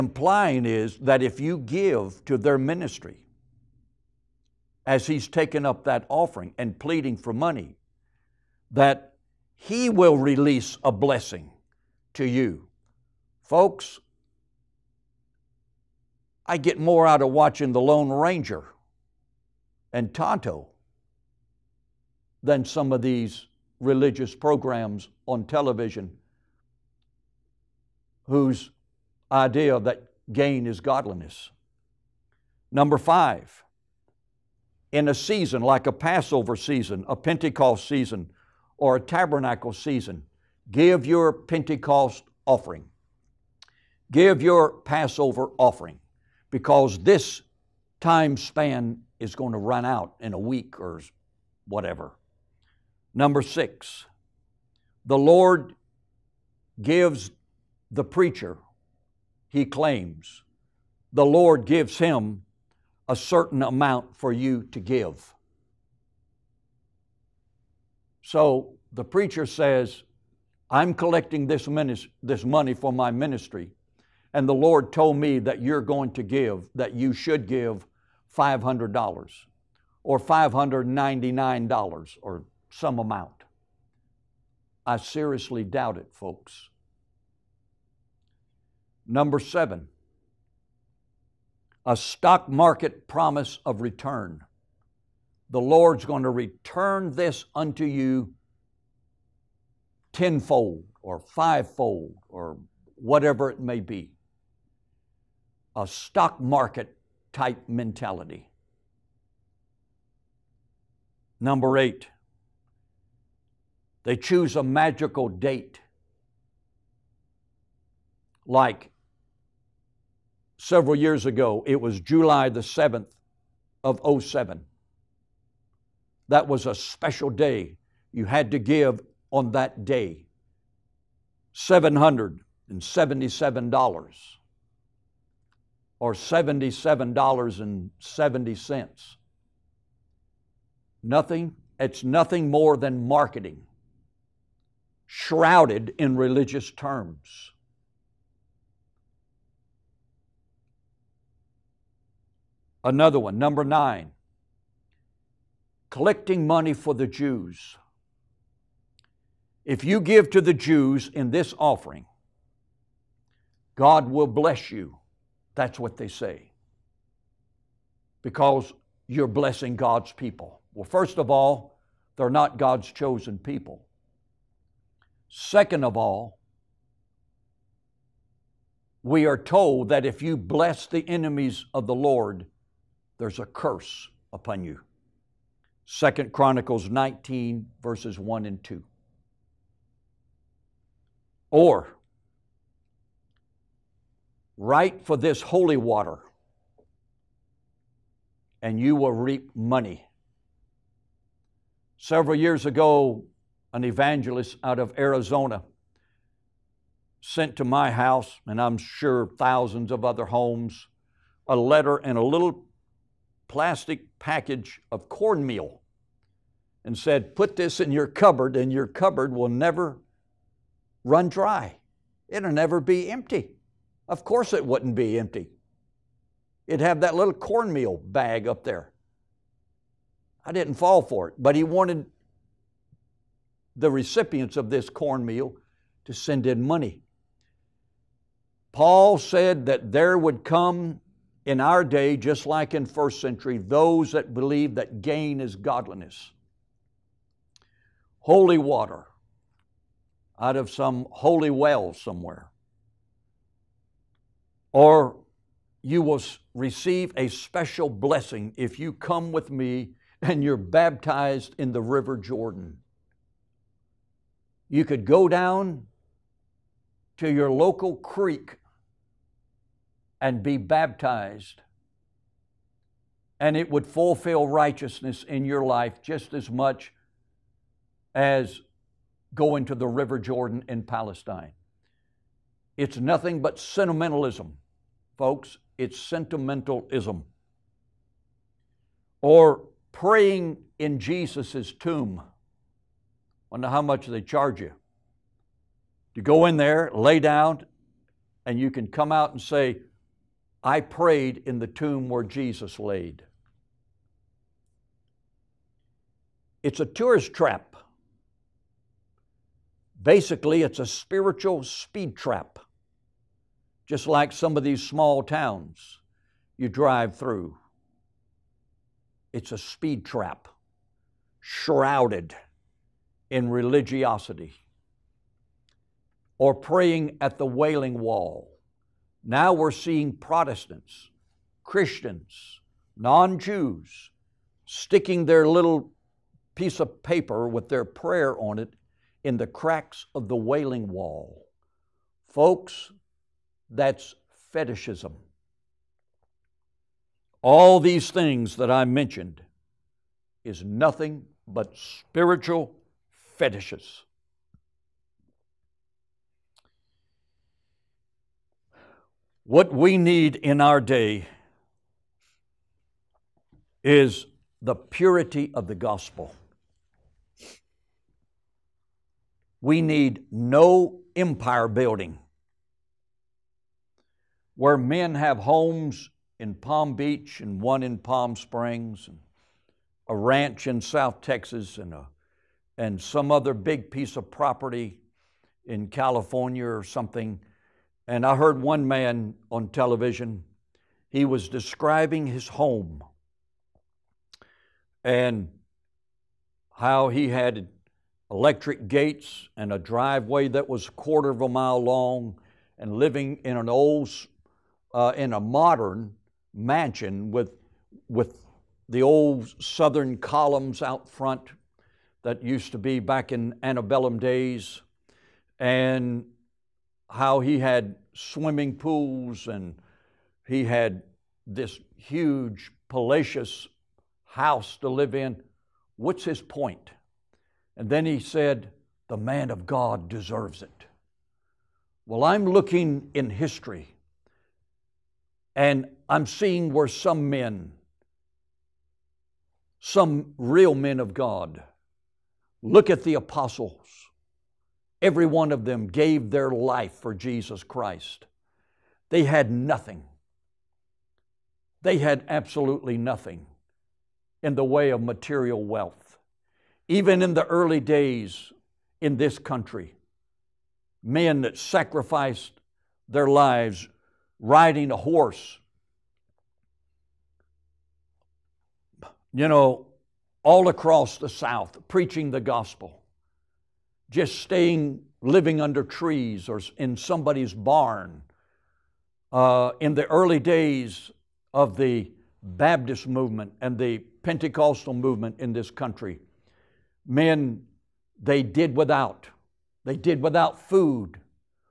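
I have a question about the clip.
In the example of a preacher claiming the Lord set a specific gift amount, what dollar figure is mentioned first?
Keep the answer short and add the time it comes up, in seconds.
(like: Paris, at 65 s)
$500, at 78 s.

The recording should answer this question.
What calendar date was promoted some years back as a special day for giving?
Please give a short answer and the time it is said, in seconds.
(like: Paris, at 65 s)
July 7, 2007, at 121 s.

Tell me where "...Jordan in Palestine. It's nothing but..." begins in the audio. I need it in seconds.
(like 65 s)
280 s.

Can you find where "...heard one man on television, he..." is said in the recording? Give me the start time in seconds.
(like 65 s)
388 s.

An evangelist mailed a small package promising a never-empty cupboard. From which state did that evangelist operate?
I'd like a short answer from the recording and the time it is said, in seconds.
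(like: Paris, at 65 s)
Arizona, at 204 s.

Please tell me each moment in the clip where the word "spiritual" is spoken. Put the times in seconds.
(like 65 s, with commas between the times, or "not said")
310 s, 351 s.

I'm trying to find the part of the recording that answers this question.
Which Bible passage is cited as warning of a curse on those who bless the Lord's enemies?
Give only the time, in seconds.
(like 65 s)
185 s.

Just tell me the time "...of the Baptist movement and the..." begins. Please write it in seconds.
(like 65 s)
481 s.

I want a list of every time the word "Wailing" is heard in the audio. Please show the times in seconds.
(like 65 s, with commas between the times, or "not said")
327 s, 340 s.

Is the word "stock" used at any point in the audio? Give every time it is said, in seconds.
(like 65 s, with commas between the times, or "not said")
91 s, 105 s.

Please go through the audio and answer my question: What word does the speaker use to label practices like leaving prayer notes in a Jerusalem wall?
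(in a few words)
Fetishism.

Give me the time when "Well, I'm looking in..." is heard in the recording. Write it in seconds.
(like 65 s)
432 s.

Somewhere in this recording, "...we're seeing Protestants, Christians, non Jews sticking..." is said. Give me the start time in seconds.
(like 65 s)
329 s.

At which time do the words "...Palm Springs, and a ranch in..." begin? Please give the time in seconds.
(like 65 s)
377 s.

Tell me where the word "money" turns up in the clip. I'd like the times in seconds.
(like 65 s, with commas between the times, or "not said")
7 s, 72 s, 156 s, 199 s, 236 s.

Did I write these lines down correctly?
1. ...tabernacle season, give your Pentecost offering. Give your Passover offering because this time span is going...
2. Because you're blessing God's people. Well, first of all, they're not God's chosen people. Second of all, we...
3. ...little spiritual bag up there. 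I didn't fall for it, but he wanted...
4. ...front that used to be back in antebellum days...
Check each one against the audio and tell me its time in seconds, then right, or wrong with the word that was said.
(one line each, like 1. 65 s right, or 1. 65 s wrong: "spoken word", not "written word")
1. 38 s right
2. 168 s right
3. 227 s wrong: "cornmeal", not "spiritual"
4. 411 s right.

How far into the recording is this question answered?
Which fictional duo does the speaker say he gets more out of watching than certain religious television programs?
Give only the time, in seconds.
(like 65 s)
17 s.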